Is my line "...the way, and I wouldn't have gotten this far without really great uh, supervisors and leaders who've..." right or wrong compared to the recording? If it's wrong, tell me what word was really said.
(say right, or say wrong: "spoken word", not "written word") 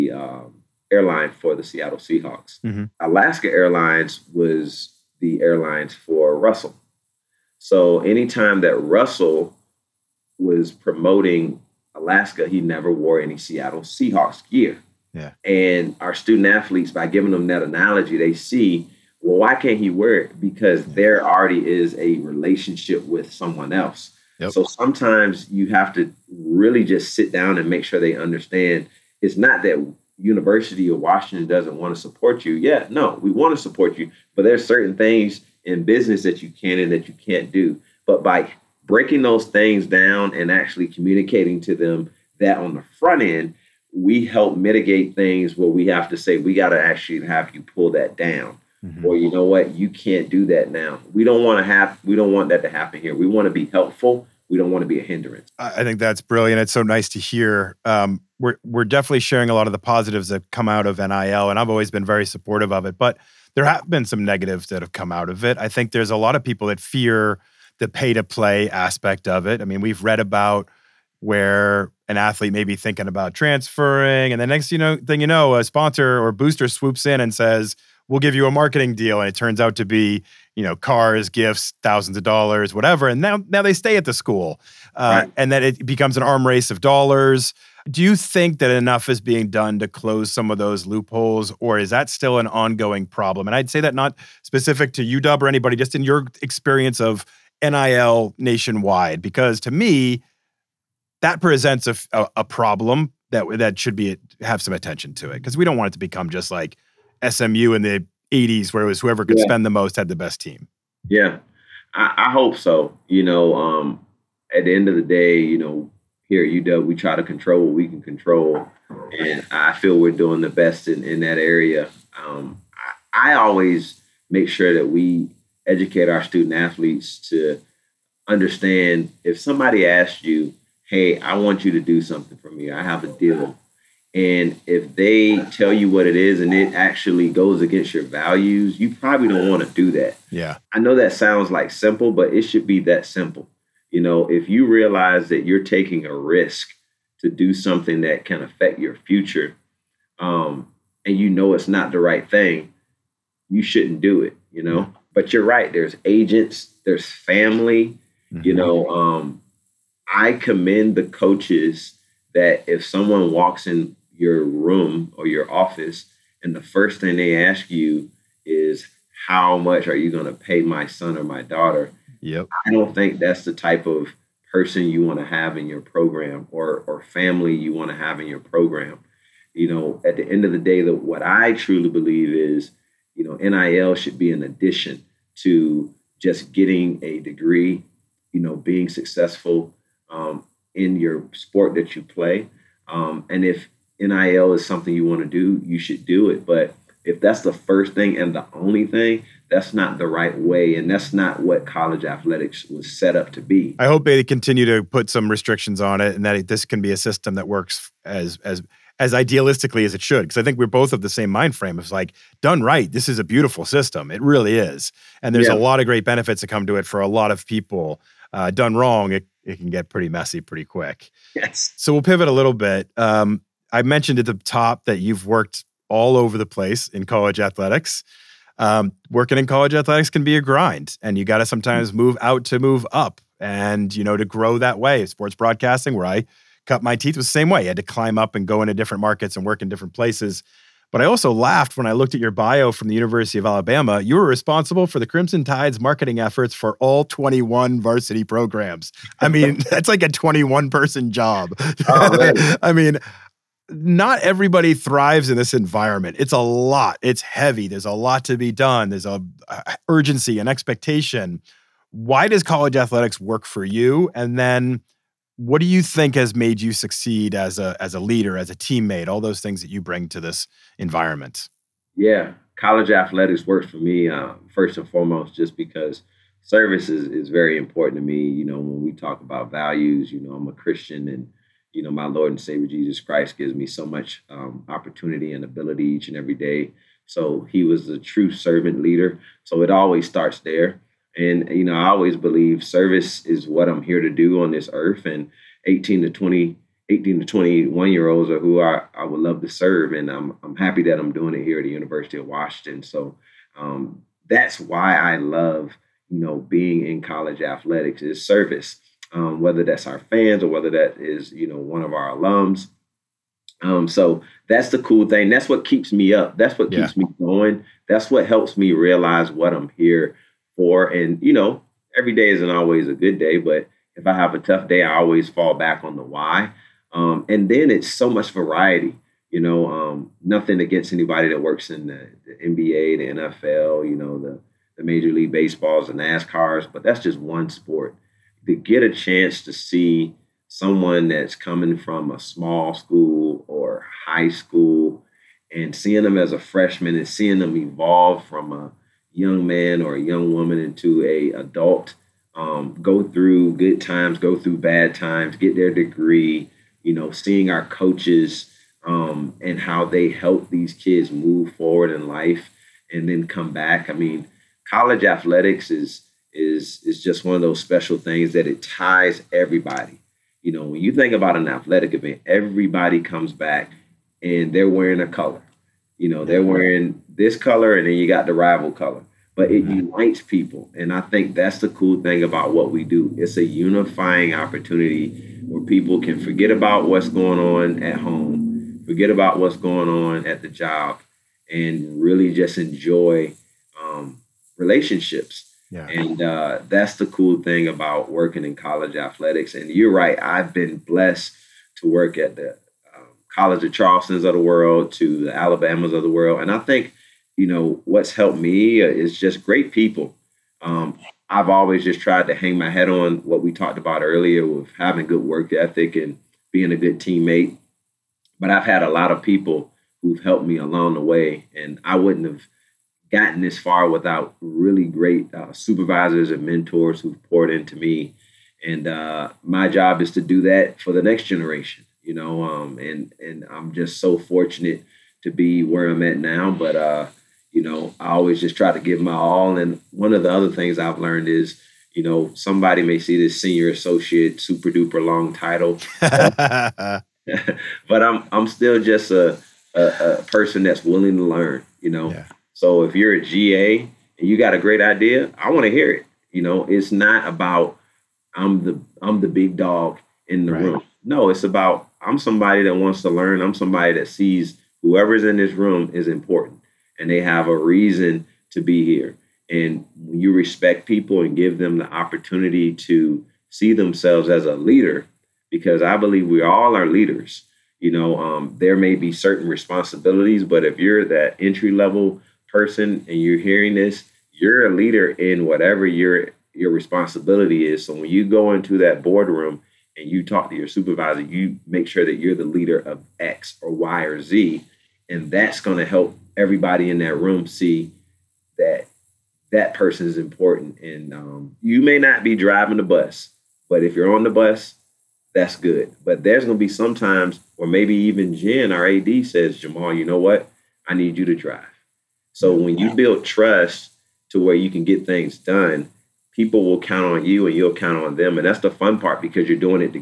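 wrong: "mentors", not "leaders".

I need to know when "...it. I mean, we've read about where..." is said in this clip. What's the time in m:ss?
1:09.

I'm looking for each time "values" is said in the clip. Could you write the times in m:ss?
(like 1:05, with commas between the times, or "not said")
2:18, 4:39.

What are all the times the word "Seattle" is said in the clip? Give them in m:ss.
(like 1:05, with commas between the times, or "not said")
0:01, 0:13.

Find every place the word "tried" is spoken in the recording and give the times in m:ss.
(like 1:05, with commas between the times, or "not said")
6:52.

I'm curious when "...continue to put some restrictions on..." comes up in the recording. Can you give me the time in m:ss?
3:24.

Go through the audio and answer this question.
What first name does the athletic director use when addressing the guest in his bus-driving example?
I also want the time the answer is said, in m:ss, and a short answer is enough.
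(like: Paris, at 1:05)
Jamaal, at 8:29.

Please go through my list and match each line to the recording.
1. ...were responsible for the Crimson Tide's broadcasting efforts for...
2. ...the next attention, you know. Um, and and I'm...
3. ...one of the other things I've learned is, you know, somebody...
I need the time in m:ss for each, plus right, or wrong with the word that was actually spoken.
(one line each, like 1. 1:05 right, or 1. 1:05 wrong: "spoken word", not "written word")
1. 4:04 wrong: "marketing", not "broadcasting"
2. 7:10 wrong: "generation", not "attention"
3. 7:19 right.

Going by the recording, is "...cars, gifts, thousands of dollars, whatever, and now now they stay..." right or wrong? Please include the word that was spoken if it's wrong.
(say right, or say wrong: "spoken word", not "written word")
right.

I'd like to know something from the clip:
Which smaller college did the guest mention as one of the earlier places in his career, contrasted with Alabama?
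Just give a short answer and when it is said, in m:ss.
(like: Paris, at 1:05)
College of Charleston, at 6:43.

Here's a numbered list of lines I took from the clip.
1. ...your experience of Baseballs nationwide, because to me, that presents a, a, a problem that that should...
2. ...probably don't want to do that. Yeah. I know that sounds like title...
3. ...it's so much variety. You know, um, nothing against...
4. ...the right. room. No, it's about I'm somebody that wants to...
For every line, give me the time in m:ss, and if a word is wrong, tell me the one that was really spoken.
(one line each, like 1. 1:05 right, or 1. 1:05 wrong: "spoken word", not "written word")
1. 1:36 wrong: "NIL", not "Baseballs"
2. 2:18 wrong: "simple", not "title"
3. 5:27 right
4. 7:40 right.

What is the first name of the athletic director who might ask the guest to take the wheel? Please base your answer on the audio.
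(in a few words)
Jen.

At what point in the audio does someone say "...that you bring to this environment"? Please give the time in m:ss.
4:29.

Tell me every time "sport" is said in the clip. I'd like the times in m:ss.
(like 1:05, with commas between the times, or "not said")
3:11, 3:55, 5:37.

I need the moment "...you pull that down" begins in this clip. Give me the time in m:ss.
0:47.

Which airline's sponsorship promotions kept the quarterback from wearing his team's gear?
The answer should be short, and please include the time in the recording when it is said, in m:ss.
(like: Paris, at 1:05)
Alaska Airlines, at 0:03.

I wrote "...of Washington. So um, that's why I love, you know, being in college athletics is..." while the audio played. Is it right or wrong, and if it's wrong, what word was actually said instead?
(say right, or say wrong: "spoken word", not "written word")
right.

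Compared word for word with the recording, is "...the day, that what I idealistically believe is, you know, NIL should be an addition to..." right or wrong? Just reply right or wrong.
wrong.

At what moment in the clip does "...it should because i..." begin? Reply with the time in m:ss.
3:29.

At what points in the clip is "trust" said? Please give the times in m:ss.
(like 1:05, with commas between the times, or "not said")
8:33.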